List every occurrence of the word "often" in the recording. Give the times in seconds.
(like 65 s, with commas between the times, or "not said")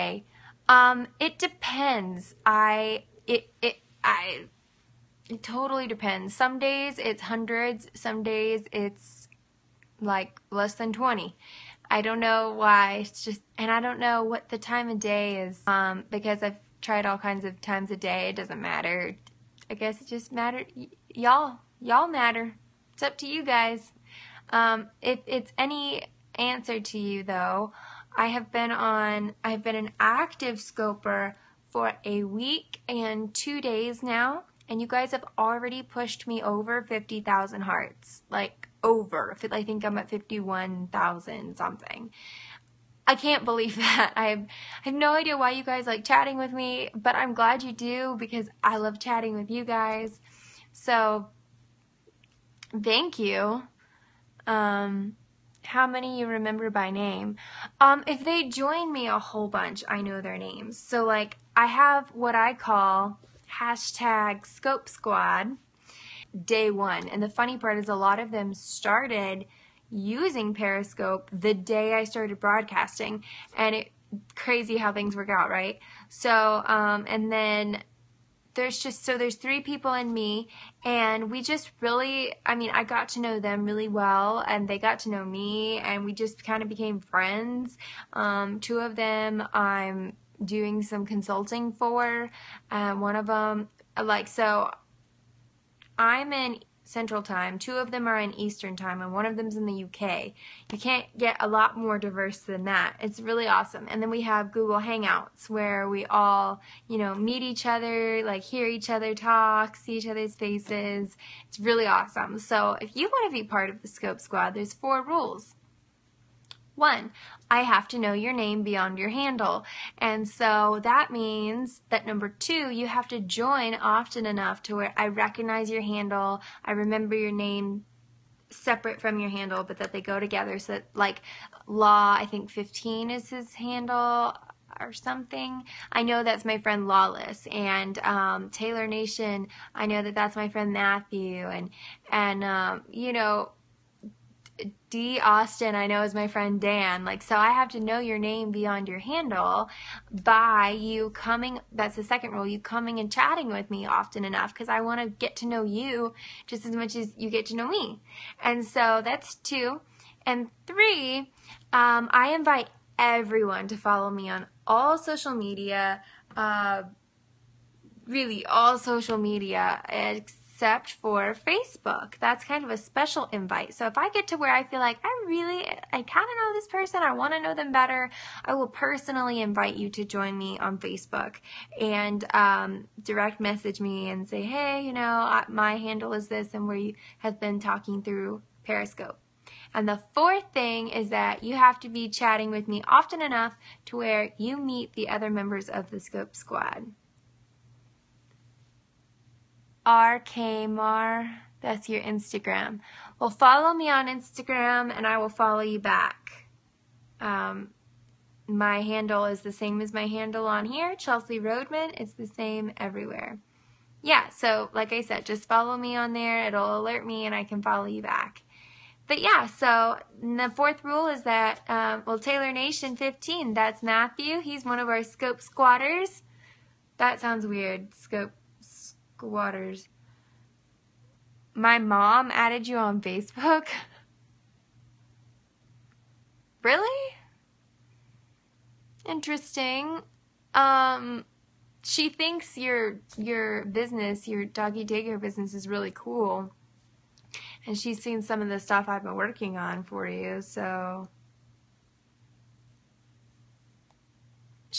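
123 s, 153 s, 192 s.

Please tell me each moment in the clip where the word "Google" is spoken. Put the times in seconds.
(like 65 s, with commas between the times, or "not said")
104 s.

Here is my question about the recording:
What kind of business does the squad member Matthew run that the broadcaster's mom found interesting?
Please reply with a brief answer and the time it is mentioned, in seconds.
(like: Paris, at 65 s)
doggy daycare, at 244 s.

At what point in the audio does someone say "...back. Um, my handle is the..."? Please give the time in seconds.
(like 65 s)
205 s.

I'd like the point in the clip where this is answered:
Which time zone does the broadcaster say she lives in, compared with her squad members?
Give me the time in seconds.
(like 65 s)
96 s.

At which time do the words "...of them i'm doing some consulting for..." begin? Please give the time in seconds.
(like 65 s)
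88 s.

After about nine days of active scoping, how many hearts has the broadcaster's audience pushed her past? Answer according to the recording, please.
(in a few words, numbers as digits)
50,000.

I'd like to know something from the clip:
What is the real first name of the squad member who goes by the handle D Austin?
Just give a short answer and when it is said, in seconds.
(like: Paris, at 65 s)
Dan, at 146 s.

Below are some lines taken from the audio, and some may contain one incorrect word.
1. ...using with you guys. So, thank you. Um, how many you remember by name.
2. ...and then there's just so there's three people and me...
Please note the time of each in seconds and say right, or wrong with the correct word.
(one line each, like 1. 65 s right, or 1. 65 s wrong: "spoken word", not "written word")
1. 48 s wrong: "chatting", not "using"
2. 77 s right.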